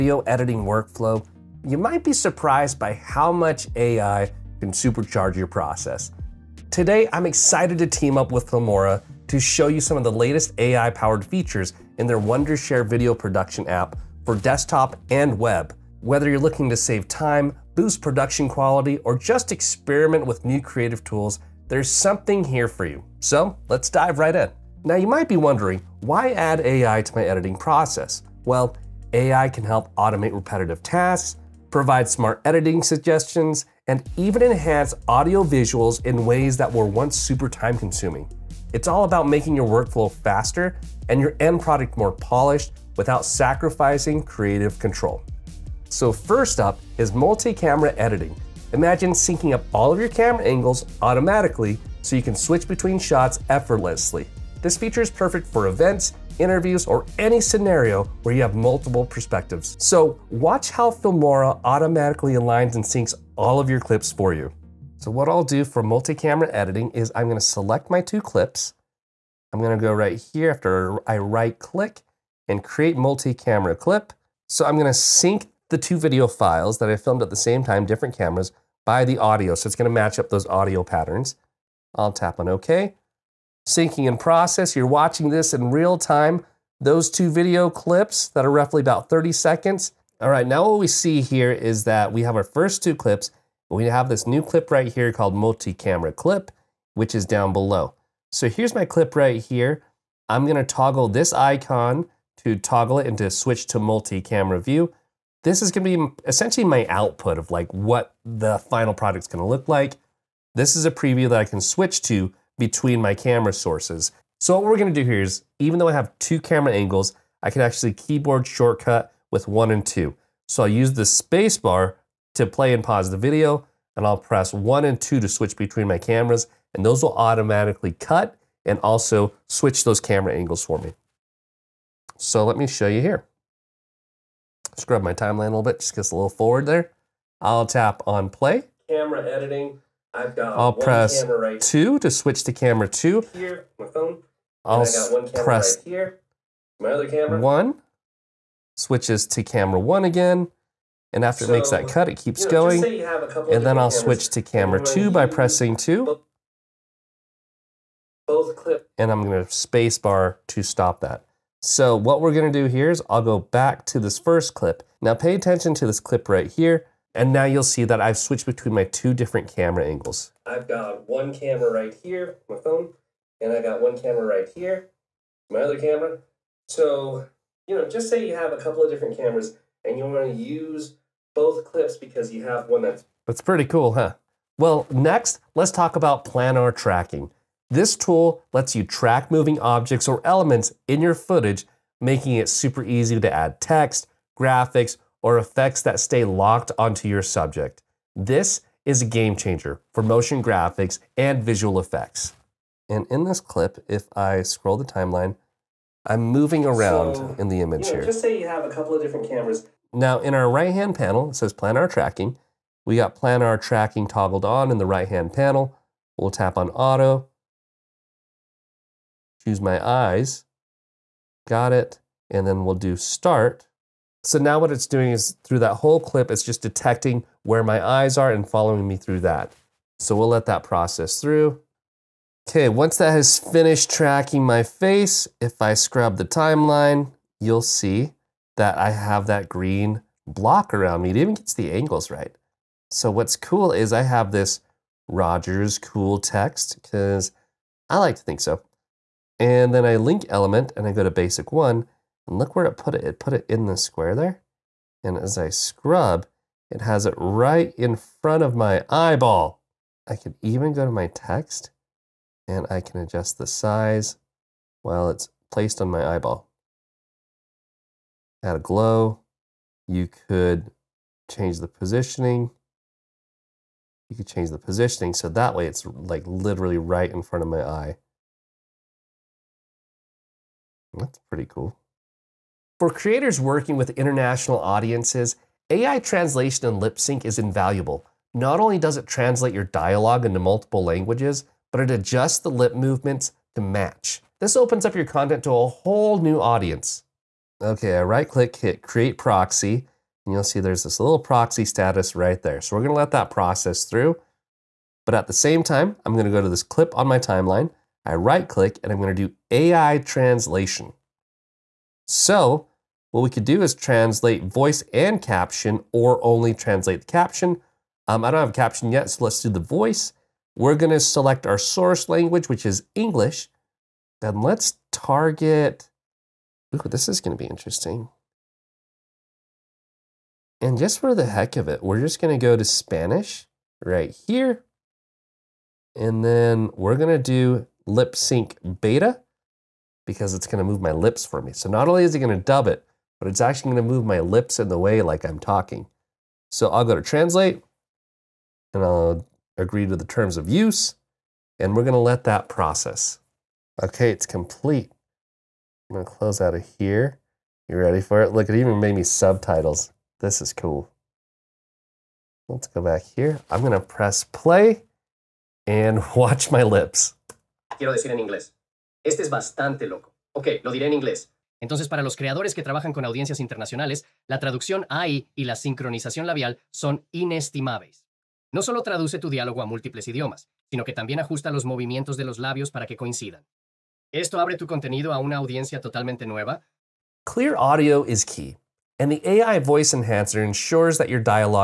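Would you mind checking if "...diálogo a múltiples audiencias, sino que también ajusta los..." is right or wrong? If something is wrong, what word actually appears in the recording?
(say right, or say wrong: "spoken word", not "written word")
wrong: "idiomas", not "audiencias".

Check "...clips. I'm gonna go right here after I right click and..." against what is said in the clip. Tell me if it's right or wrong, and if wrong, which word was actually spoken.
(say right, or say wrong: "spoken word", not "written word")
right.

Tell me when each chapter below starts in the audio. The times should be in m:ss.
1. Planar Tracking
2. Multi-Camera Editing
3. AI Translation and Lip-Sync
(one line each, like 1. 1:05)
1. 3:03
2. 0:46
3. 4:41.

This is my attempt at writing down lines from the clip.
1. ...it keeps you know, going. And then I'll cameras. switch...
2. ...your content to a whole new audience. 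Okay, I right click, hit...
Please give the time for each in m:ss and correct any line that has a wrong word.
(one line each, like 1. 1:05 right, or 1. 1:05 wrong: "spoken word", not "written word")
1. 2:32 right
2. 4:54 right.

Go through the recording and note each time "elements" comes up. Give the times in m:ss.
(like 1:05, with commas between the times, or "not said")
3:10, 4:10.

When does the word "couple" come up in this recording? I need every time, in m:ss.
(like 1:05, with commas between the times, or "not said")
2:58, 3:28.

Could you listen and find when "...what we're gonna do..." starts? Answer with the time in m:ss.
2:41.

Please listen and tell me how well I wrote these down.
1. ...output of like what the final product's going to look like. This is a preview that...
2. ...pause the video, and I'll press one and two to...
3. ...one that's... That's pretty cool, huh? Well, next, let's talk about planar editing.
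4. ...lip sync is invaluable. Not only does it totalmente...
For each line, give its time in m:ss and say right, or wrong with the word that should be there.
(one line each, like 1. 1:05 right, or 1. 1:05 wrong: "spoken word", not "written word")
1. 1:46 right
2. 2:02 right
3. 3:02 wrong: "tracking", not "editing"
4. 4:46 wrong: "translate", not "totalmente".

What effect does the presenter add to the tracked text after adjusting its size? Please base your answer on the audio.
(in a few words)
a glow.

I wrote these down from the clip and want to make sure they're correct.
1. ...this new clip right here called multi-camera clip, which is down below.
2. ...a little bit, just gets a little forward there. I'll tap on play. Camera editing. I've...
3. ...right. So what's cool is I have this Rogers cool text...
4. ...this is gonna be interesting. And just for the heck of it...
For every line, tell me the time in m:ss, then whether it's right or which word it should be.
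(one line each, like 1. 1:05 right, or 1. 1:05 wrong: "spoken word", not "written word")
1. 1:34 right
2. 2:15 right
3. 4:02 right
4. 5:26 right.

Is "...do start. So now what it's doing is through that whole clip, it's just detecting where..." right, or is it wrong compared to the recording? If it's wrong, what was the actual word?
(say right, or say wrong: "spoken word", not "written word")
right.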